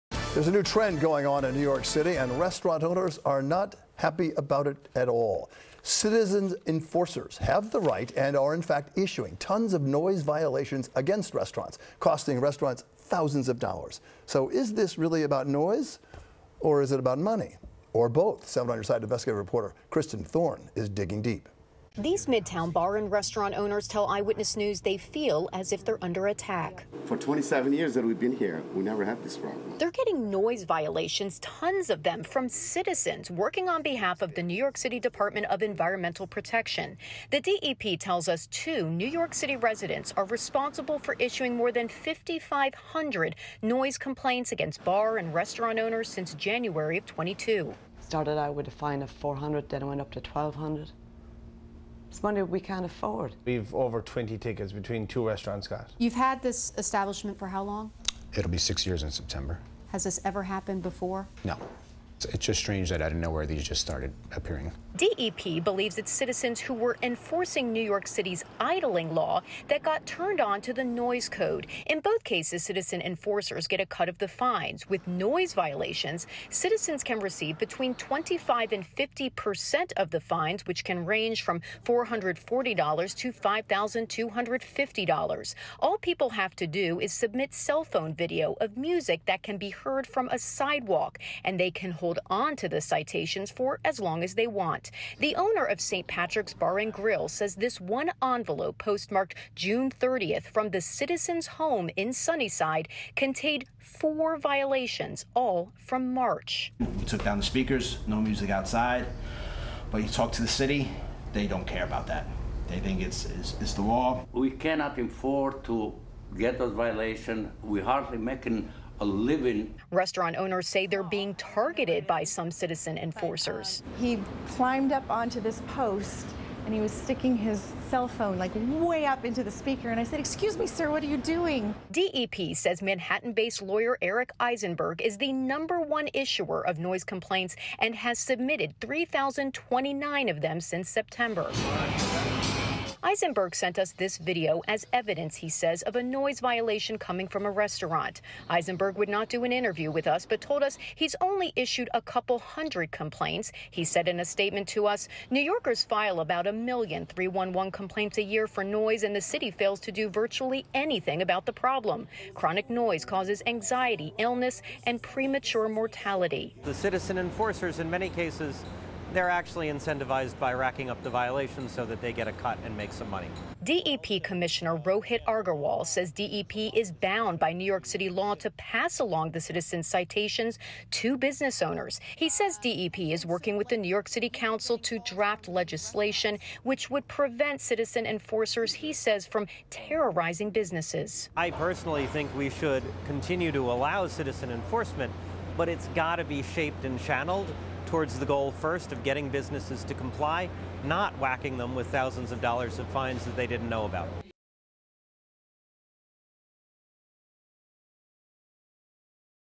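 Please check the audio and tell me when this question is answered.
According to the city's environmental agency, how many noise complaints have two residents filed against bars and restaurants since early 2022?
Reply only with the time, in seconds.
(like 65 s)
41 s.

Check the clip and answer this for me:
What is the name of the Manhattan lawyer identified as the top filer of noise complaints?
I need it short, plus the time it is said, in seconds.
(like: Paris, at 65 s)
Eric Eisenberg, at 134 s.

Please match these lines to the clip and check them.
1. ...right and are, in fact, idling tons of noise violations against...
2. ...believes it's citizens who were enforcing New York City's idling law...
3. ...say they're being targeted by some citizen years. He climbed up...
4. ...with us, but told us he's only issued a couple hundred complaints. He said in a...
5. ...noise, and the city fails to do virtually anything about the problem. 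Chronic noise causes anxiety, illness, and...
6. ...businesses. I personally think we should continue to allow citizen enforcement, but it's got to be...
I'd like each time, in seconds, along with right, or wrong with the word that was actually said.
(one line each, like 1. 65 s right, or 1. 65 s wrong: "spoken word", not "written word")
1. 7 s wrong: "issuing", not "idling"
2. 65 s right
3. 120 s wrong: "enforcers", not "years"
4. 149 s right
5. 158 s right
6. 190 s right.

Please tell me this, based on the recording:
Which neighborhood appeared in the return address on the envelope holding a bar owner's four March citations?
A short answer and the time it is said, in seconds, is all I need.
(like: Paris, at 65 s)
Sunnyside, at 102 s.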